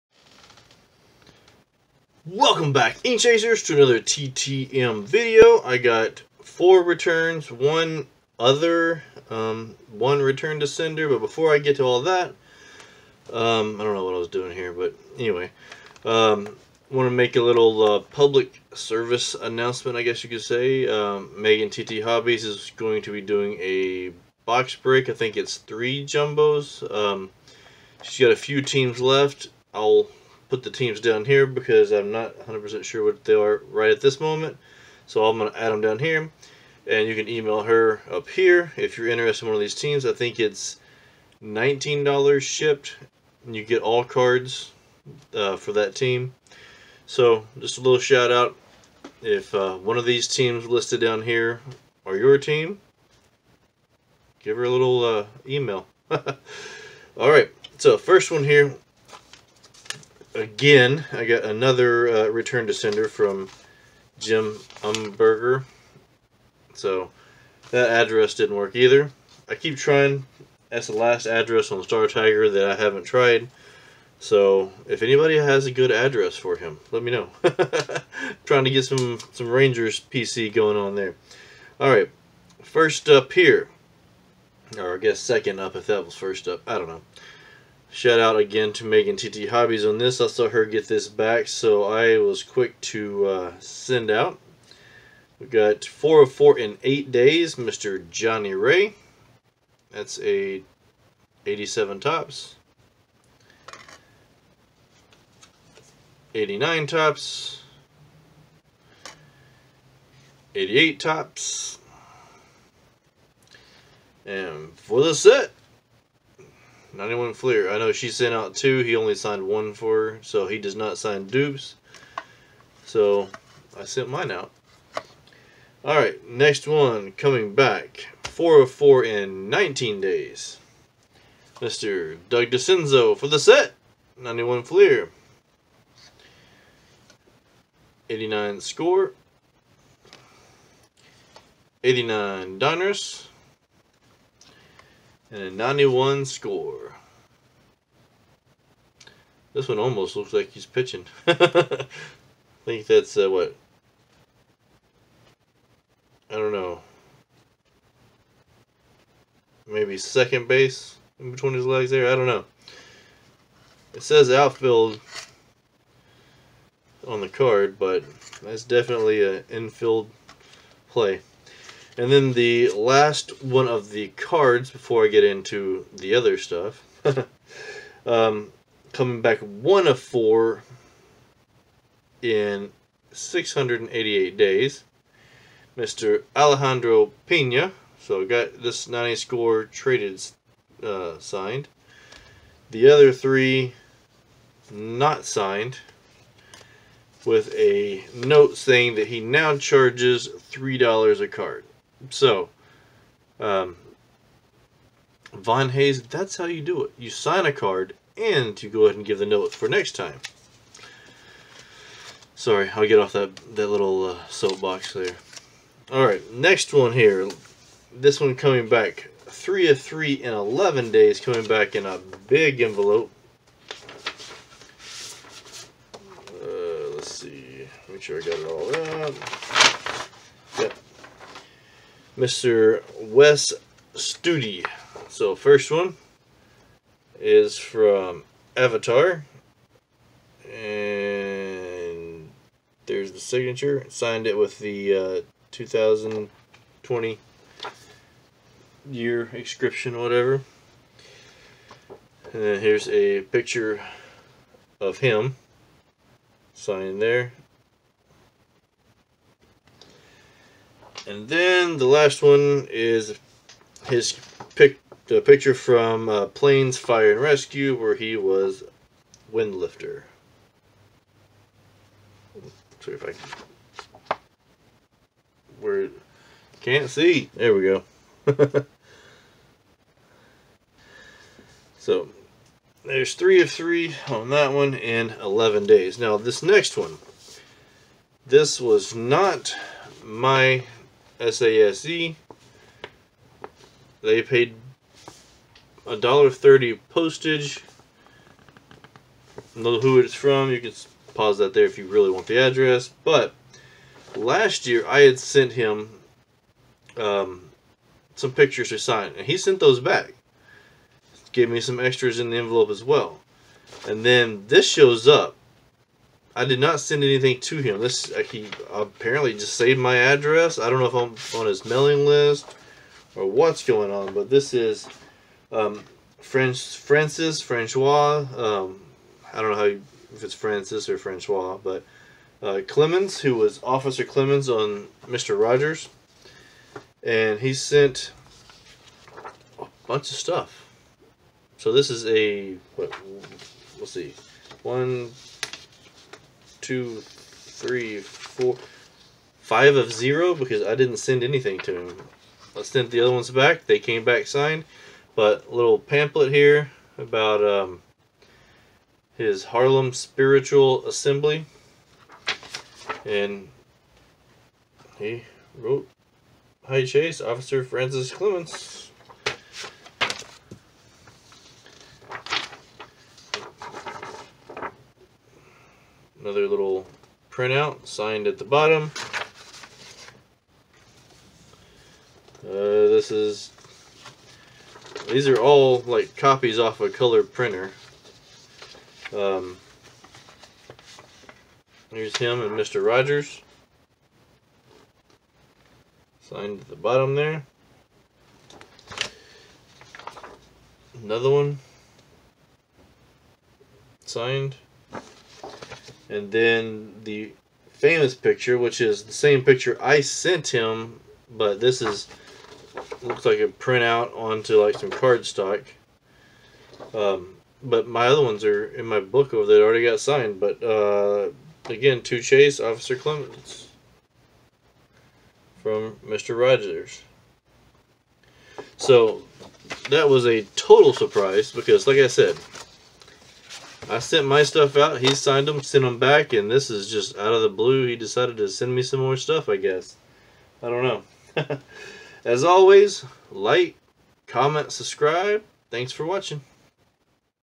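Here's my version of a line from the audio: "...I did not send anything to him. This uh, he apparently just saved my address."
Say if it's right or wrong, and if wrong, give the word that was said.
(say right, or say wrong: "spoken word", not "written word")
right.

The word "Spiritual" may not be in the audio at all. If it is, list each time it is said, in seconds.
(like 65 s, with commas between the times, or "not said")
359 s.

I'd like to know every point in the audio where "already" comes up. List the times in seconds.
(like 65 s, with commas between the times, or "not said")
419 s.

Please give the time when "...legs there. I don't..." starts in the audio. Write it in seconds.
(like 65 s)
161 s.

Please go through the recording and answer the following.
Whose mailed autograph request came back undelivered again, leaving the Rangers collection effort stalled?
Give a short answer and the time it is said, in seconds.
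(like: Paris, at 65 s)
Jim Umbarger, at 64 s.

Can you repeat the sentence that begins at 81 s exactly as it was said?
All right, first up here, or I guess second up if that was first up.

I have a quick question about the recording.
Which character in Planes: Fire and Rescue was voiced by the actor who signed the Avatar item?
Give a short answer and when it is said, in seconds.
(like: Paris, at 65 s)
Windlifter, at 269 s.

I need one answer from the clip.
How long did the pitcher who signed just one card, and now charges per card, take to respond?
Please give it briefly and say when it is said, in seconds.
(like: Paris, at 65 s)
688 days, at 183 s.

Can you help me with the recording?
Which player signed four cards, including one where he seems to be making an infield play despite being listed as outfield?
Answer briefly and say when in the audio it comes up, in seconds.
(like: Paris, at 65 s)
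Doug Dascenzo, at 132 s.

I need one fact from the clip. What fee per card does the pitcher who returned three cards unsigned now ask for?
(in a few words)
$3.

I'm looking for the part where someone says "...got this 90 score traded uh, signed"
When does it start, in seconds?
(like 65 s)
188 s.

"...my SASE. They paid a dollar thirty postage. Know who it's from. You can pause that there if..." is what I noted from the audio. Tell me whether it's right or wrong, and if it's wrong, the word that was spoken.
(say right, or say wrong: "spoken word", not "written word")
right.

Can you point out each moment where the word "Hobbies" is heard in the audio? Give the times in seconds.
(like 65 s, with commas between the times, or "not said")
22 s, 89 s.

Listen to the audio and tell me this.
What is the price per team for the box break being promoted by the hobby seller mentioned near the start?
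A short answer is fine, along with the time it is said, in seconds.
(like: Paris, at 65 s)
$19 shipped, at 41 s.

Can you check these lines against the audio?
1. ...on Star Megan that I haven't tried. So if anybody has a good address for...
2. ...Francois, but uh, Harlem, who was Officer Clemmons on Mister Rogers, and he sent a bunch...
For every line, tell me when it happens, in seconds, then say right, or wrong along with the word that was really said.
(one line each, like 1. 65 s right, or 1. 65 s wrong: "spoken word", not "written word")
1. 71 s wrong: "Tiger", not "Megan"
2. 330 s wrong: "Clemmons", not "Harlem".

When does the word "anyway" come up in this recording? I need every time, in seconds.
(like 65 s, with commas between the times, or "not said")
15 s.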